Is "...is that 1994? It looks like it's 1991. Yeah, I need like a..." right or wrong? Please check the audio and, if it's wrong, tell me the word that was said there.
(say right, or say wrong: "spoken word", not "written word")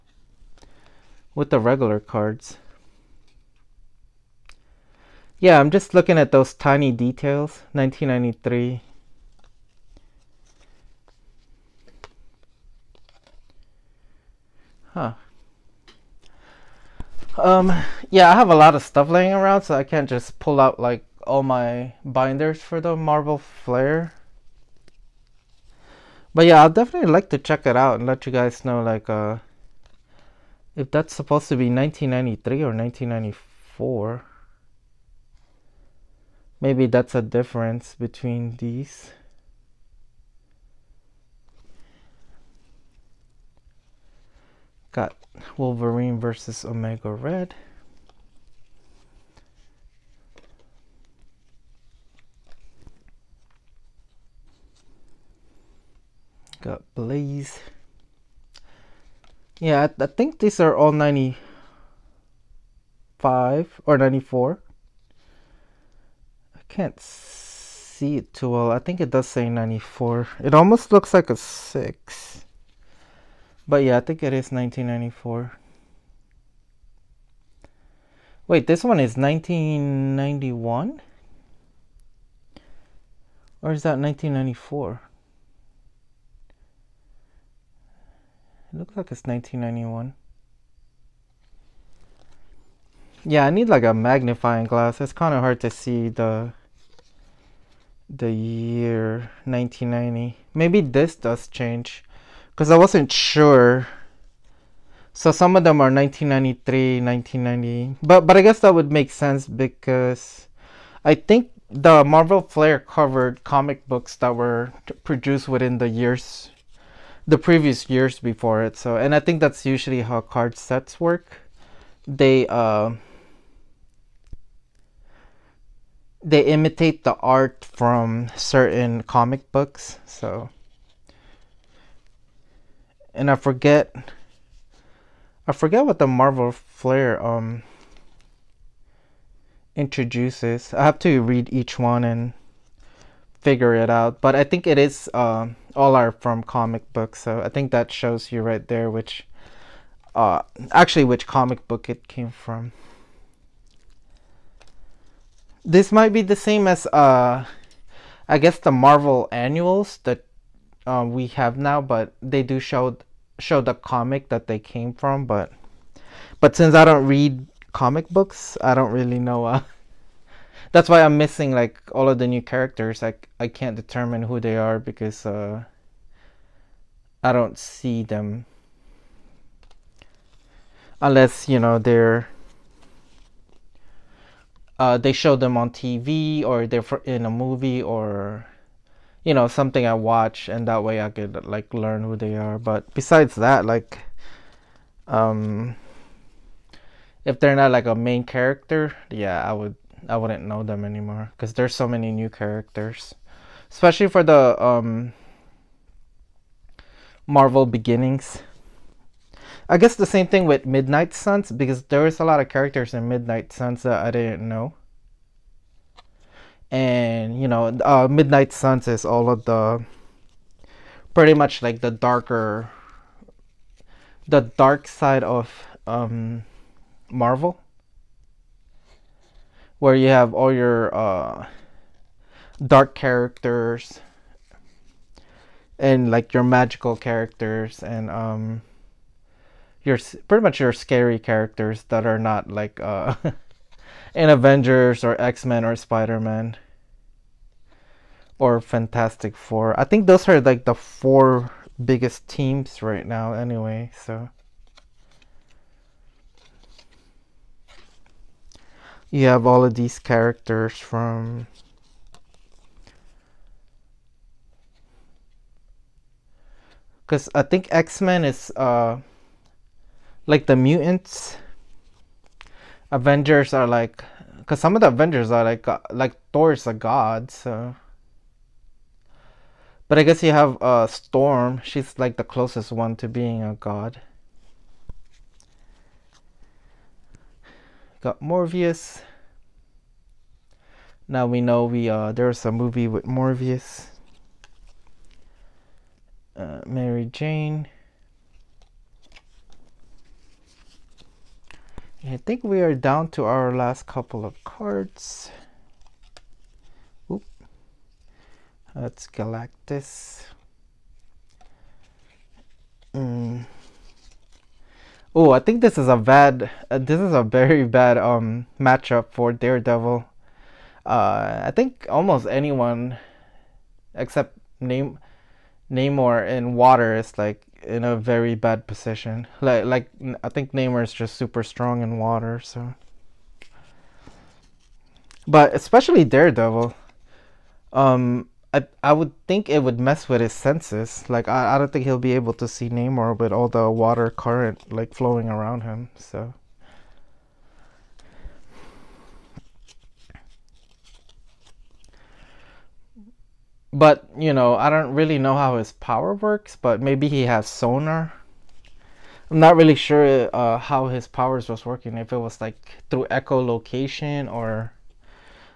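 right.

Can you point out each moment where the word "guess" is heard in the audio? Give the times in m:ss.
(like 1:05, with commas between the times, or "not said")
1:48, 2:38, 3:29, 4:40.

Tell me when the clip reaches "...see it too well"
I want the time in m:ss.
1:07.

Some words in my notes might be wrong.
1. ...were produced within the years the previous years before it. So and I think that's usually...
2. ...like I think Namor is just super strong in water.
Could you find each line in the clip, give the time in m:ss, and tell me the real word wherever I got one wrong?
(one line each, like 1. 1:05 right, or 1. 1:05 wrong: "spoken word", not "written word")
1. 1:54 right
2. 5:29 right.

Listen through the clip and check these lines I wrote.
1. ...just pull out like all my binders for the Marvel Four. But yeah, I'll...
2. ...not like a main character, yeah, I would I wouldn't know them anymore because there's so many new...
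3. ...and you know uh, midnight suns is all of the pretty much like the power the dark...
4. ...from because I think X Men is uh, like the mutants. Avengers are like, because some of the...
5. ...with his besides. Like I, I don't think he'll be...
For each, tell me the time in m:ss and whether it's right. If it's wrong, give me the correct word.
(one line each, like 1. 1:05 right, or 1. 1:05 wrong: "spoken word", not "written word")
1. 0:20 wrong: "Flair", not "Four"
2. 3:17 right
3. 3:36 wrong: "darker", not "power"
4. 4:20 right
5. 5:40 wrong: "senses", not "besides".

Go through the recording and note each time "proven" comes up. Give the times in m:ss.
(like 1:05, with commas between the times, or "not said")
not said.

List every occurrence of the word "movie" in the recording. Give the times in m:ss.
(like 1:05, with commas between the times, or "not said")
3:07, 4:52.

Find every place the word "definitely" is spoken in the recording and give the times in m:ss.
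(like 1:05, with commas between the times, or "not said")
0:26.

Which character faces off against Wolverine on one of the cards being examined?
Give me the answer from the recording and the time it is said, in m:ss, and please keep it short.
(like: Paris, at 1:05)
Omega Red, at 0:46.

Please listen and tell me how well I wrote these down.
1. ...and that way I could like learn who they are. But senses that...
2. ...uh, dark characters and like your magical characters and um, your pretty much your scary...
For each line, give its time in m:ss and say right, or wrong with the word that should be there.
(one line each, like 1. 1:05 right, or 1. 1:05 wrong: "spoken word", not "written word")
1. 3:10 wrong: "besides", not "senses"
2. 3:50 right.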